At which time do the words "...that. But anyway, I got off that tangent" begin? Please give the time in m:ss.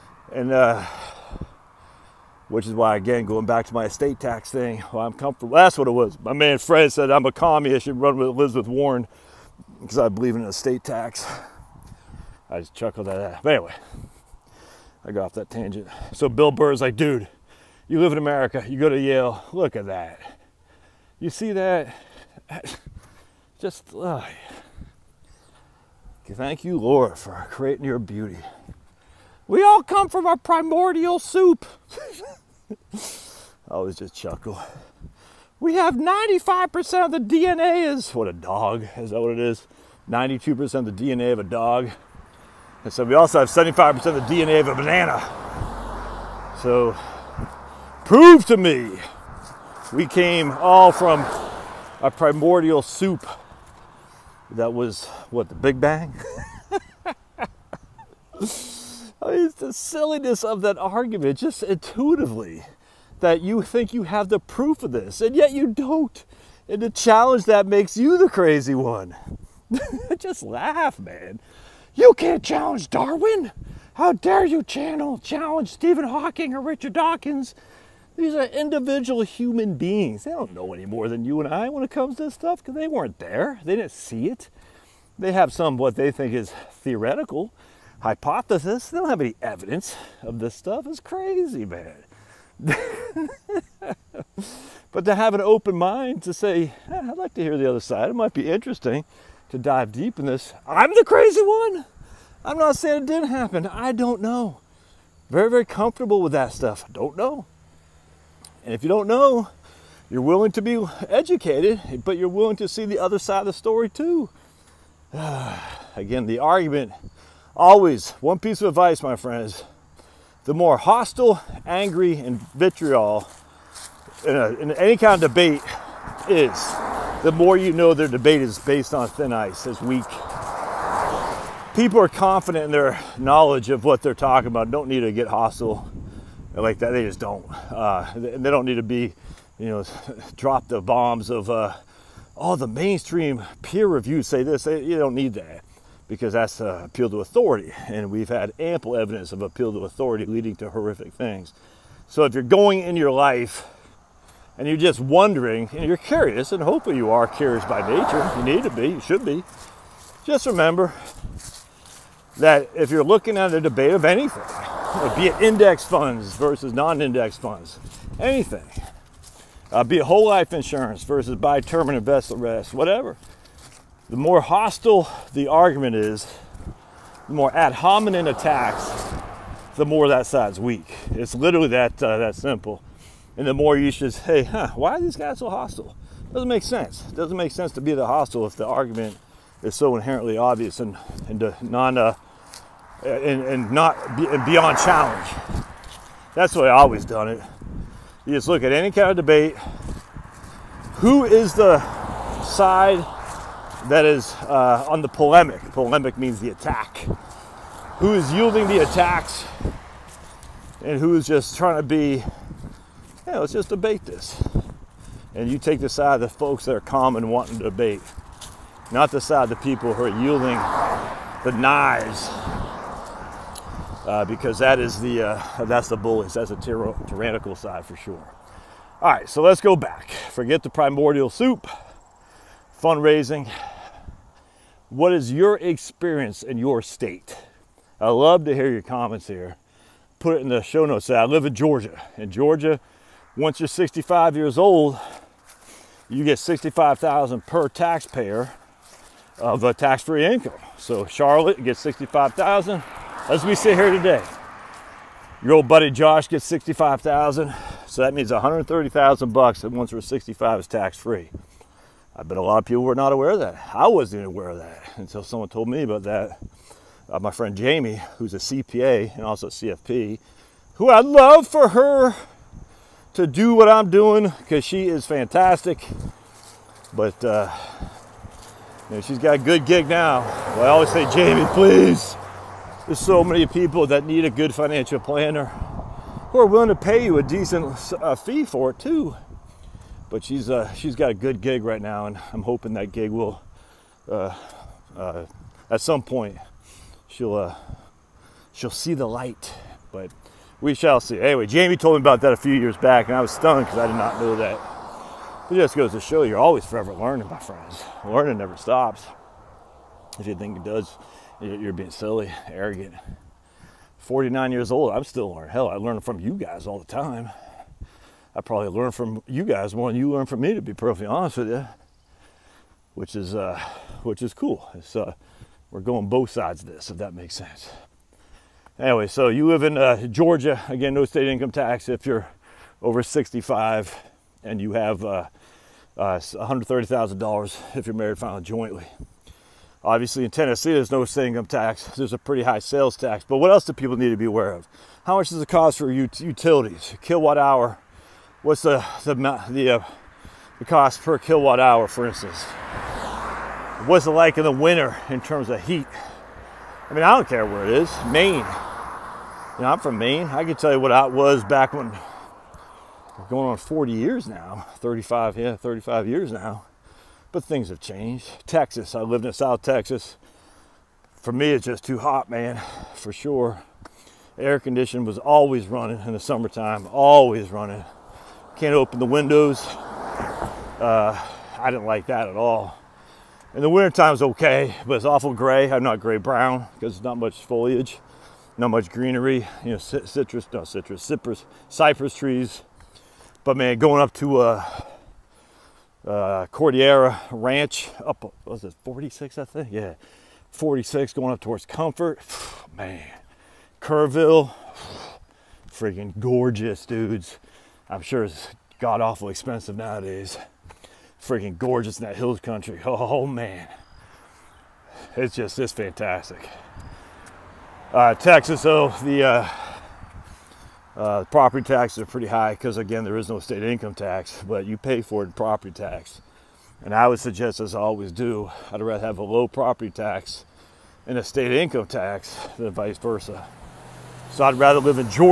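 0:13.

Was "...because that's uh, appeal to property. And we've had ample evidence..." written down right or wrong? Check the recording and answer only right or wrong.
wrong.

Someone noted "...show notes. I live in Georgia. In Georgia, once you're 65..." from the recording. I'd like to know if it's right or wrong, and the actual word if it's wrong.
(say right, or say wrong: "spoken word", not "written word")
right.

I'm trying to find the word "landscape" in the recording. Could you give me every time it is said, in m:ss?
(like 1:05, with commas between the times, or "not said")
not said.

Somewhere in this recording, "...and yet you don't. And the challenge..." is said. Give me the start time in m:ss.
1:05.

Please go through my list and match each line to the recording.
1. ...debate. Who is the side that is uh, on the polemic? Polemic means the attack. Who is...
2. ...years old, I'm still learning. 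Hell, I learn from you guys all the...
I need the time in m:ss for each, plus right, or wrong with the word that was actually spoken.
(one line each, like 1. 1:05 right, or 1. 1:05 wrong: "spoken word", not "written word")
1. 3:19 right
2. 5:14 right.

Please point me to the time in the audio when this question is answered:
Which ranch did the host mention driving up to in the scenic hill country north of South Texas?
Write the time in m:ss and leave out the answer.
6:36.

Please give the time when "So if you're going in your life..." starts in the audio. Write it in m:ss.
2:32.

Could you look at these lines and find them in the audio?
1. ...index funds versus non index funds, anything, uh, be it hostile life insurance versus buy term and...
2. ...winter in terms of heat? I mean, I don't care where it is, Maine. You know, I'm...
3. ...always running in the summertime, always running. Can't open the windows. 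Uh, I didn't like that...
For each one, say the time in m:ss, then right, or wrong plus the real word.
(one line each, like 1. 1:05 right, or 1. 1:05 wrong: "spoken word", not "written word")
1. 2:45 wrong: "whole", not "hostile"
2. 5:54 right
3. 6:15 right.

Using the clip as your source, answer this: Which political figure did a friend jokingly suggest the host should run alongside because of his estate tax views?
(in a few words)
Elizabeth Warren.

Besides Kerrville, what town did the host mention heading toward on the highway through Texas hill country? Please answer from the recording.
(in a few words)
Comfort.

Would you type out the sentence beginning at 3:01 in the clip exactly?
It's literally that, uh, that simple and the more you should say, huh, why are these guys so hostile?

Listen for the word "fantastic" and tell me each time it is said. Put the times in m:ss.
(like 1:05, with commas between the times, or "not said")
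4:35, 6:55.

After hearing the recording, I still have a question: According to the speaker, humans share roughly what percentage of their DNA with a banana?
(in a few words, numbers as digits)
75%.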